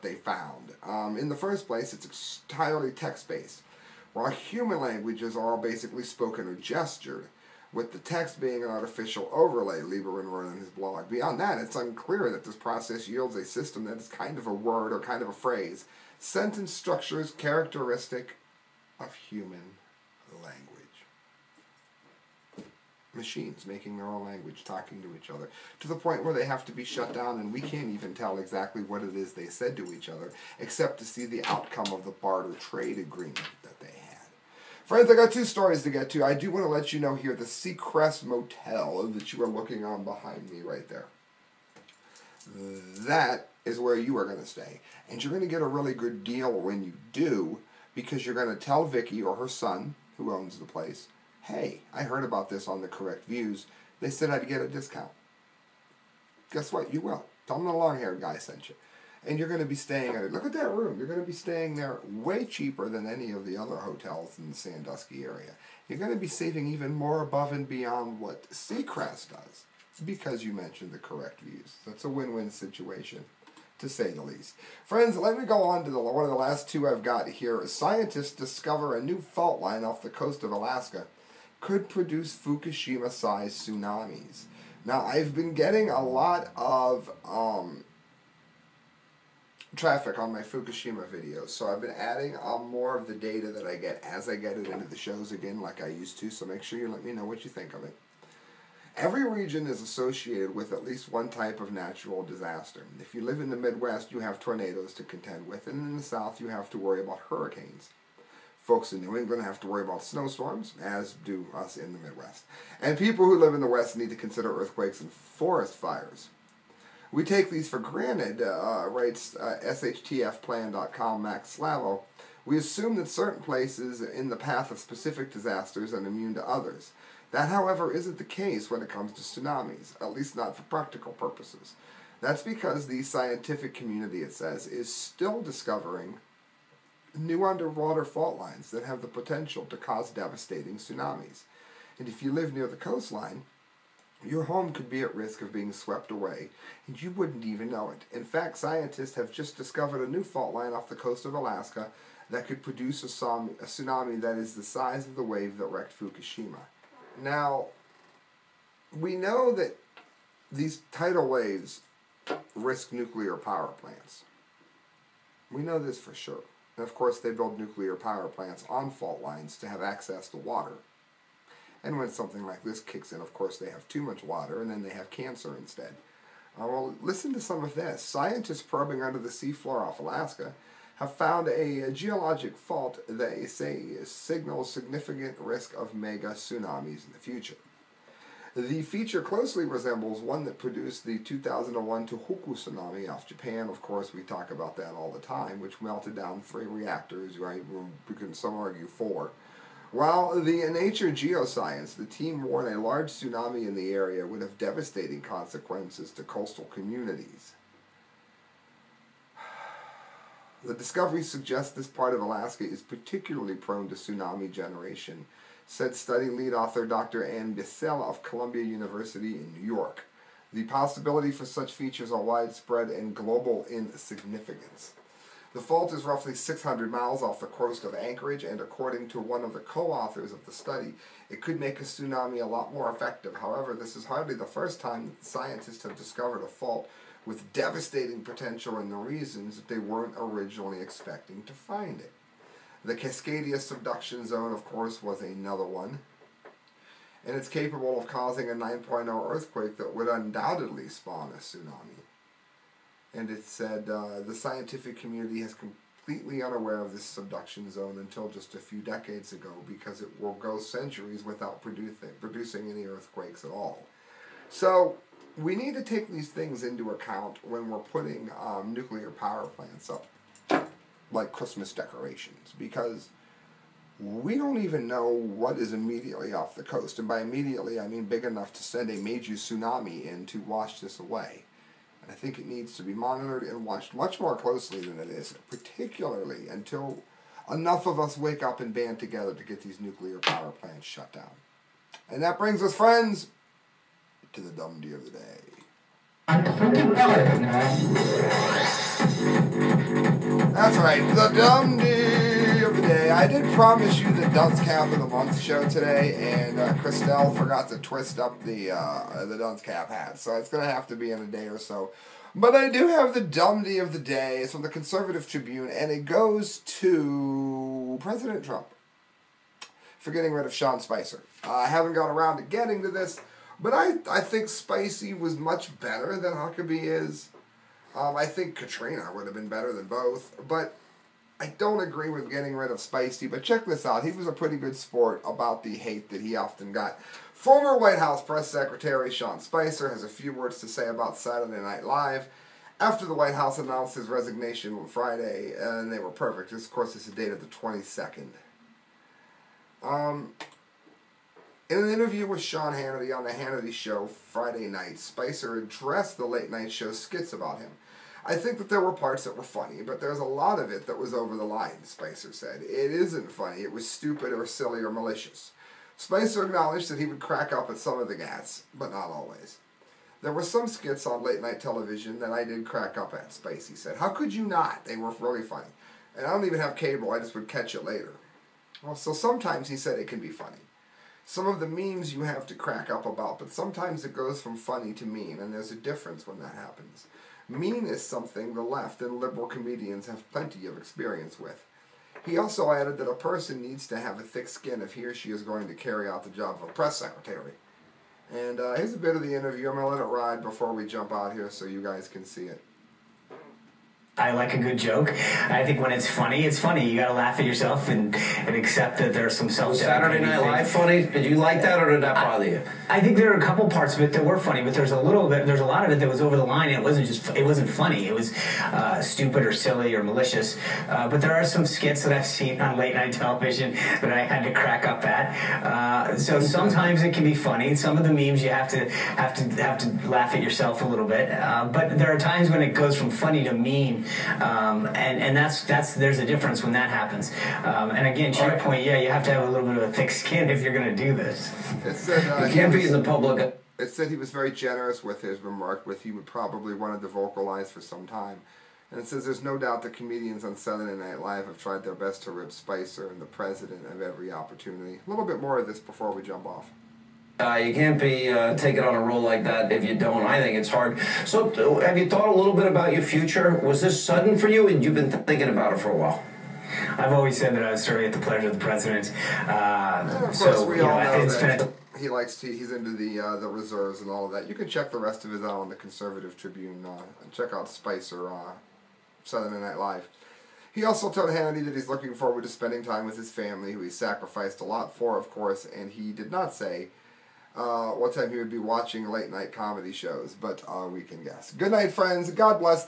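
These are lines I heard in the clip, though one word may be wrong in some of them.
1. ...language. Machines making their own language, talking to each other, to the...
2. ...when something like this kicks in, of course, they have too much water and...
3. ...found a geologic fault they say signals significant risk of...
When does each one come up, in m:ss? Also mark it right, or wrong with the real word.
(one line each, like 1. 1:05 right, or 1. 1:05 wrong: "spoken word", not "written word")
1. 0:20 right
2. 2:51 right
3. 3:01 right.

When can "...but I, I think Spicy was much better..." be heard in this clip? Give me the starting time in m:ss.
5:23.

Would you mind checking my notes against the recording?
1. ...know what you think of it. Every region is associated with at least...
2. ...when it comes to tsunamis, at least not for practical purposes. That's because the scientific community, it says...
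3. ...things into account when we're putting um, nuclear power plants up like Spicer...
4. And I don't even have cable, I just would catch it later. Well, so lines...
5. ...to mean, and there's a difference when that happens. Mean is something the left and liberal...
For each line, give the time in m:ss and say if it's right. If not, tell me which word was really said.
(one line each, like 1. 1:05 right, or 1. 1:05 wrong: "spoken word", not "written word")
1. 1:37 right
2. 2:08 right
3. 4:26 wrong: "Christmas", not "Spicer"
4. 6:16 wrong: "sometimes", not "lines"
5. 6:24 right.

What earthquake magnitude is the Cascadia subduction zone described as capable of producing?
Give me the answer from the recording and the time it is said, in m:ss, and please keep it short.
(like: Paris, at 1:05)
9.0, at 4:08.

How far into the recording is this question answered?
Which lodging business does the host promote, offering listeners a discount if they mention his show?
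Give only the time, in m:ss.
0:37.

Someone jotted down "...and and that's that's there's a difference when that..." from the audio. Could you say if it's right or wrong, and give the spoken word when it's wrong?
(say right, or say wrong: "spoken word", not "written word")
right.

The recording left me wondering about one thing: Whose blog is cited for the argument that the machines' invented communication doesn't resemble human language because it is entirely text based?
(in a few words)
Liberman.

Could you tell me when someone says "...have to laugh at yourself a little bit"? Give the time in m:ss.
7:09.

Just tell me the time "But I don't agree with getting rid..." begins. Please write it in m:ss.
5:30.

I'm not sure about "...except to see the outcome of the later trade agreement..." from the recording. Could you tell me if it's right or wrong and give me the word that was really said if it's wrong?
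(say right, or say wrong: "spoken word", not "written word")
wrong: "barter", not "later".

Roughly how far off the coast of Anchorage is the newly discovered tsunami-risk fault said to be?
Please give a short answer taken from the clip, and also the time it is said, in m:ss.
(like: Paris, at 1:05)
600 miles, at 3:46.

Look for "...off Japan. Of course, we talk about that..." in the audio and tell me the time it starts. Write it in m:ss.
3:13.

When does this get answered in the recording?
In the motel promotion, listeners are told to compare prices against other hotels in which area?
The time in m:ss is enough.
1:04.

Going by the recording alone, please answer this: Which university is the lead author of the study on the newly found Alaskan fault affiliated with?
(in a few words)
Columbia University.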